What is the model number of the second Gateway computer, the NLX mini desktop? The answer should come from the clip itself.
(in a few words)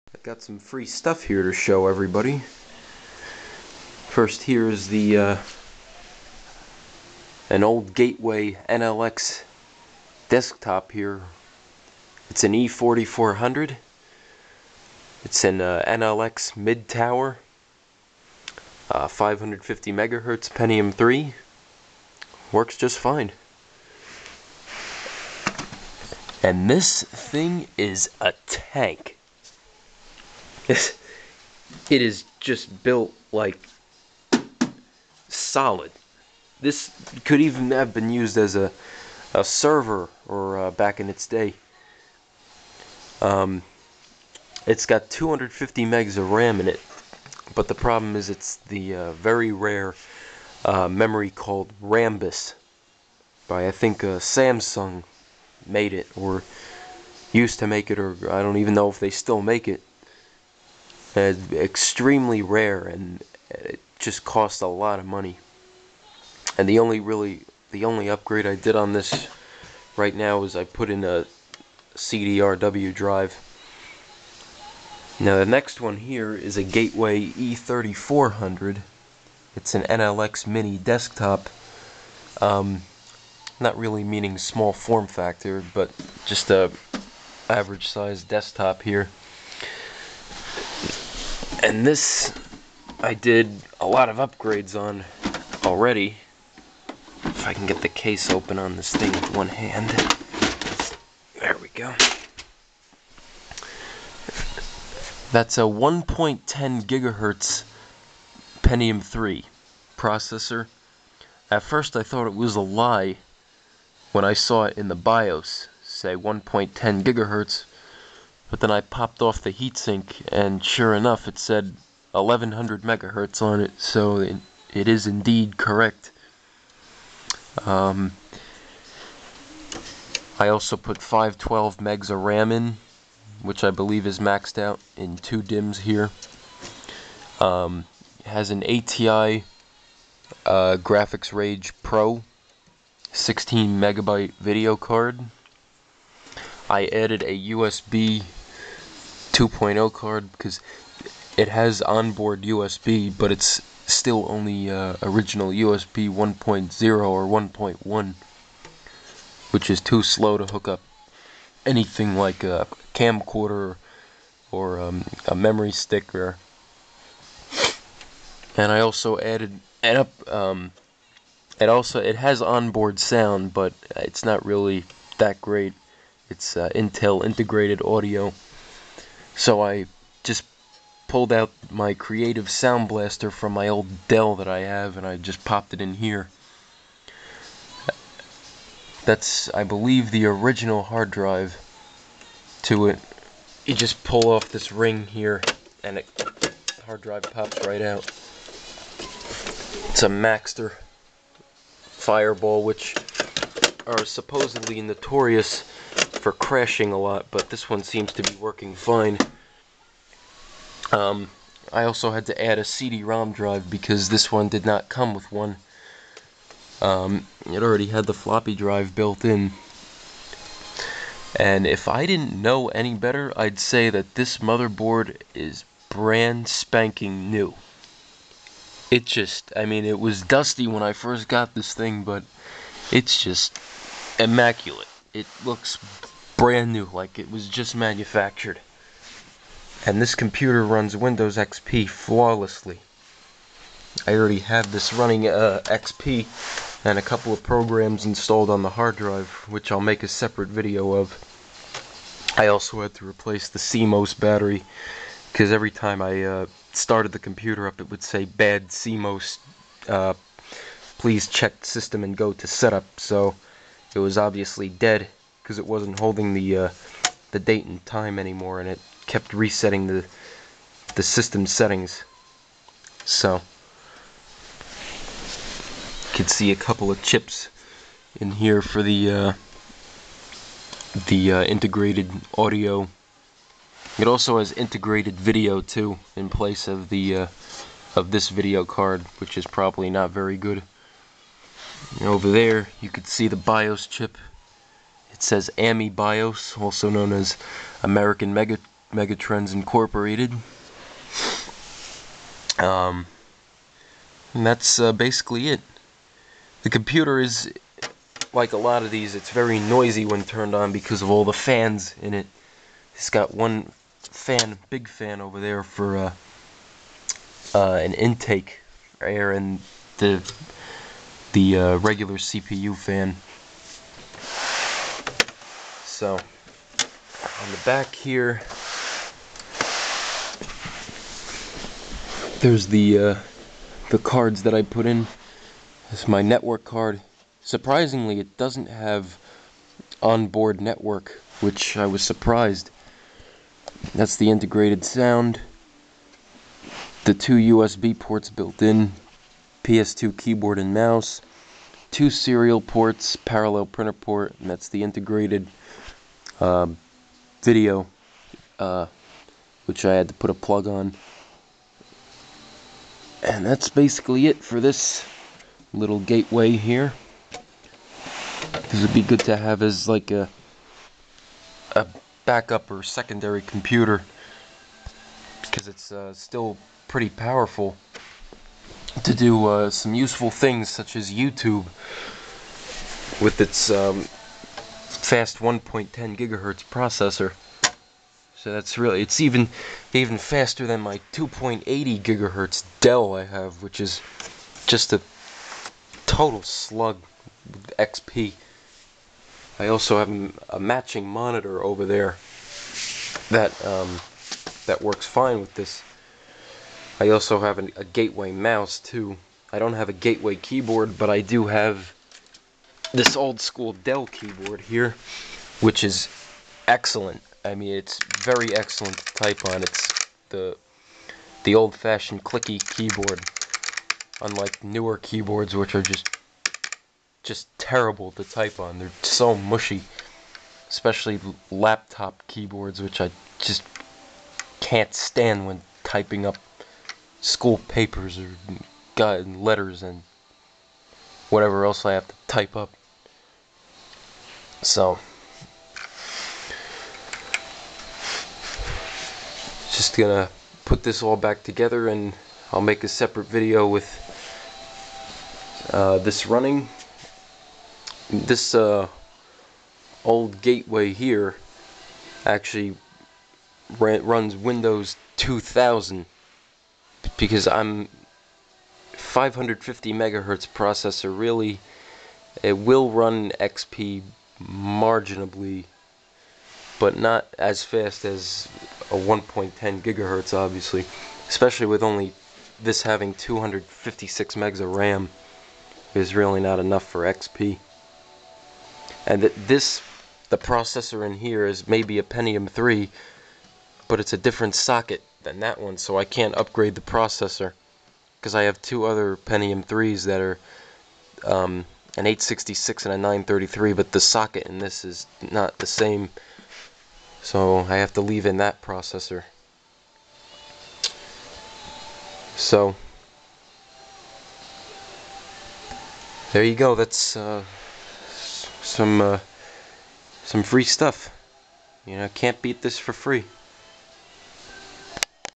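E3400.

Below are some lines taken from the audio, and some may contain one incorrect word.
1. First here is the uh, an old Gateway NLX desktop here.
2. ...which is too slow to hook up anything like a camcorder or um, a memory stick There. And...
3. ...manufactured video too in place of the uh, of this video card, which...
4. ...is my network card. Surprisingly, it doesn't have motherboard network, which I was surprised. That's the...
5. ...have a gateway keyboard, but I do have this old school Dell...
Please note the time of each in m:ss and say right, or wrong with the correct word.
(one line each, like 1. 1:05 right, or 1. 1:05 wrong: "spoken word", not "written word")
1. 0:04 right
2. 2:39 right
3. 4:44 wrong: "integrated", not "manufactured"
4. 5:36 wrong: "onboard", not "motherboard"
5. 6:49 right.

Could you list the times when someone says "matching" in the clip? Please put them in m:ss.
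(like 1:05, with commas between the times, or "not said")
6:40.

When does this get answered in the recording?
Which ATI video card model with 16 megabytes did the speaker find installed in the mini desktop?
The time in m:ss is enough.
2:21.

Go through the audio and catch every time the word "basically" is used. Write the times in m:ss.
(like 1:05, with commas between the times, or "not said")
5:04, 6:03.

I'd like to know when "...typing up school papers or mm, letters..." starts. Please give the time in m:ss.
7:15.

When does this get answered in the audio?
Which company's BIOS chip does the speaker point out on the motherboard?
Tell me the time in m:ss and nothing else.
4:55.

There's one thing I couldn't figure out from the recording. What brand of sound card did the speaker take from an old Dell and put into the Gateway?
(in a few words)
Creative Sound Blaster.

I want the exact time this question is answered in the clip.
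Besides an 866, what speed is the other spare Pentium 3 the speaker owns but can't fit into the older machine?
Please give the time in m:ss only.
8:22.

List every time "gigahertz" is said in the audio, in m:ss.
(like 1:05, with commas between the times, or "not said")
1:46, 1:57, 6:26, 6:32, 7:59.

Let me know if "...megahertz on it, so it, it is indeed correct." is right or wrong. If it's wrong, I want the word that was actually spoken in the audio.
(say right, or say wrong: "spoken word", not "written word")
right.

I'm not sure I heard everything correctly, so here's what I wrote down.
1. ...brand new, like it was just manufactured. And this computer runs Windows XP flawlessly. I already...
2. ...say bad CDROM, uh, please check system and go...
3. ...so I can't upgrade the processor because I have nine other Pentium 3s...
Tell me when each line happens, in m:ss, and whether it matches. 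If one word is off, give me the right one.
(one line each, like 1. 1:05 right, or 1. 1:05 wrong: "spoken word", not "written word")
1. 3:56 right
2. 4:18 wrong: "CMOS", not "CDROM"
3. 8:15 wrong: "two", not "nine".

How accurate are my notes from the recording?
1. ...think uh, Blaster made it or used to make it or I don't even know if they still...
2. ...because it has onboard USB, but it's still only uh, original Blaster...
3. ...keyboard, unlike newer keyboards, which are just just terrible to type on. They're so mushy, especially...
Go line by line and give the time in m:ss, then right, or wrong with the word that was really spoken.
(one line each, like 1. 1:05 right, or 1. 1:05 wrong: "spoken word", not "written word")
1. 0:53 wrong: "Samsung", not "Blaster"
2. 2:30 wrong: "USB", not "Blaster"
3. 7:02 right.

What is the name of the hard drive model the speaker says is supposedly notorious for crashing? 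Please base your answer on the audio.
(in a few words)
Maxtor Fireball.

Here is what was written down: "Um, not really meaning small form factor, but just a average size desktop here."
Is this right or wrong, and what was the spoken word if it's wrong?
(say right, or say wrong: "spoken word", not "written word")
right.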